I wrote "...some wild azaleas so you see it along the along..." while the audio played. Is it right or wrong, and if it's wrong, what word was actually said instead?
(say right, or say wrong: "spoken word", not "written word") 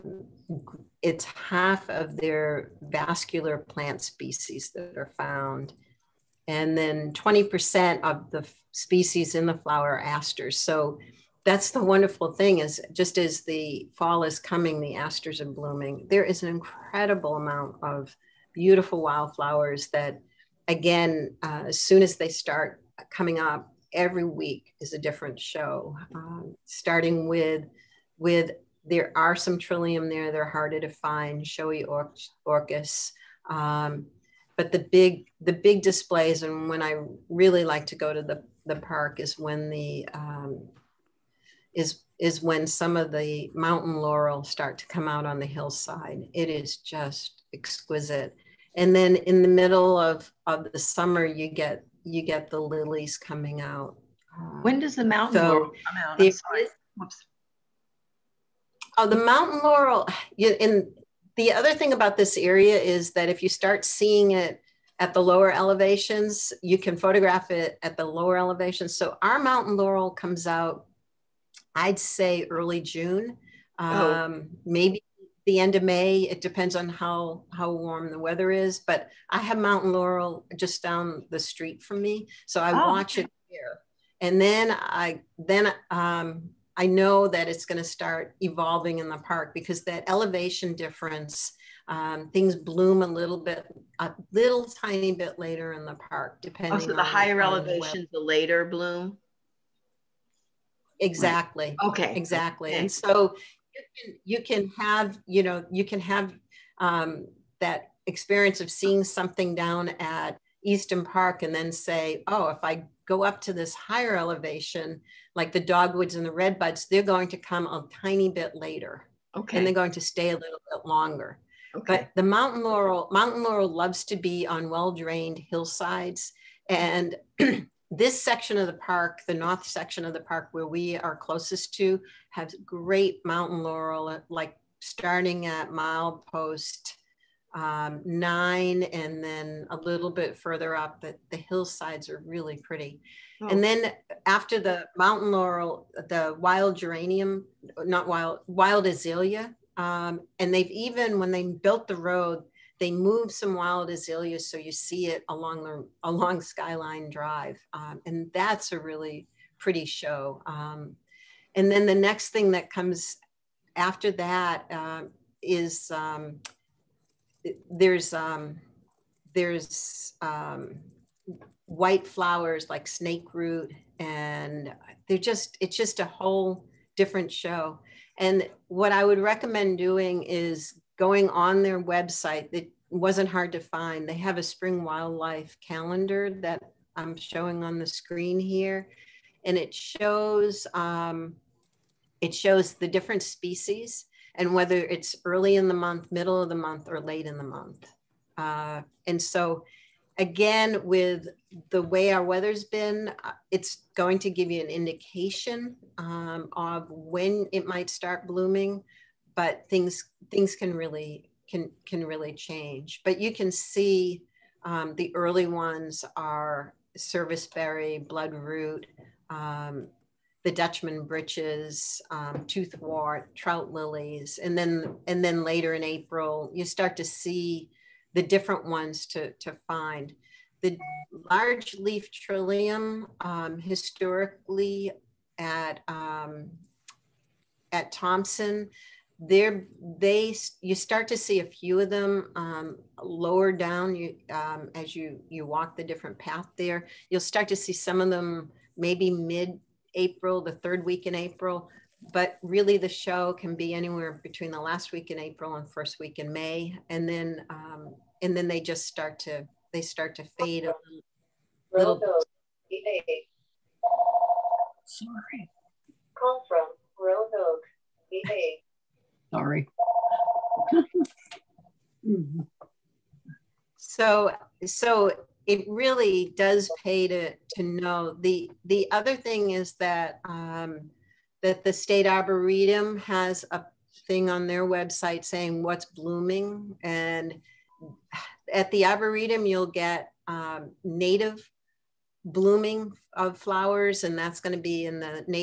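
right.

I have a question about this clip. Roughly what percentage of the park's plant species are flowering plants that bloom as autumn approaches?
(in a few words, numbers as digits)
20%.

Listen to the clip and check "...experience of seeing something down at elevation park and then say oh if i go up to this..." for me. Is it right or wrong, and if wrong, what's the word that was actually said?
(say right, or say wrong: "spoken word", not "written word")
wrong: "easton", not "elevation".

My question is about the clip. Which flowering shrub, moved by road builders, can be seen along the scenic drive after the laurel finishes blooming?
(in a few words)
wild azalea.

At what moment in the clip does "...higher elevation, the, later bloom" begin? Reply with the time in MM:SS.
01:37.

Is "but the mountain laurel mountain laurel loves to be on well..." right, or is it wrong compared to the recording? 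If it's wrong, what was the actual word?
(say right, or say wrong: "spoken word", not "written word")
right.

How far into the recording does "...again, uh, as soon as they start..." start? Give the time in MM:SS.
00:20.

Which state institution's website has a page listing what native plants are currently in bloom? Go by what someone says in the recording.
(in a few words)
State Arboretum.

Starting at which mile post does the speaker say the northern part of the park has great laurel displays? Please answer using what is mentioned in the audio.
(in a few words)
9.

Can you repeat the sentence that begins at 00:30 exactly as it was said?
They're harder to find, showy or- orchis.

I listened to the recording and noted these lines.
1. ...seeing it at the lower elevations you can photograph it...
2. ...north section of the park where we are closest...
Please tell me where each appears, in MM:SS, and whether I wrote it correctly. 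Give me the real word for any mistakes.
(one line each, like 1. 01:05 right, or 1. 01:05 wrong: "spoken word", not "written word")
1. 01:03 right
2. 02:09 right.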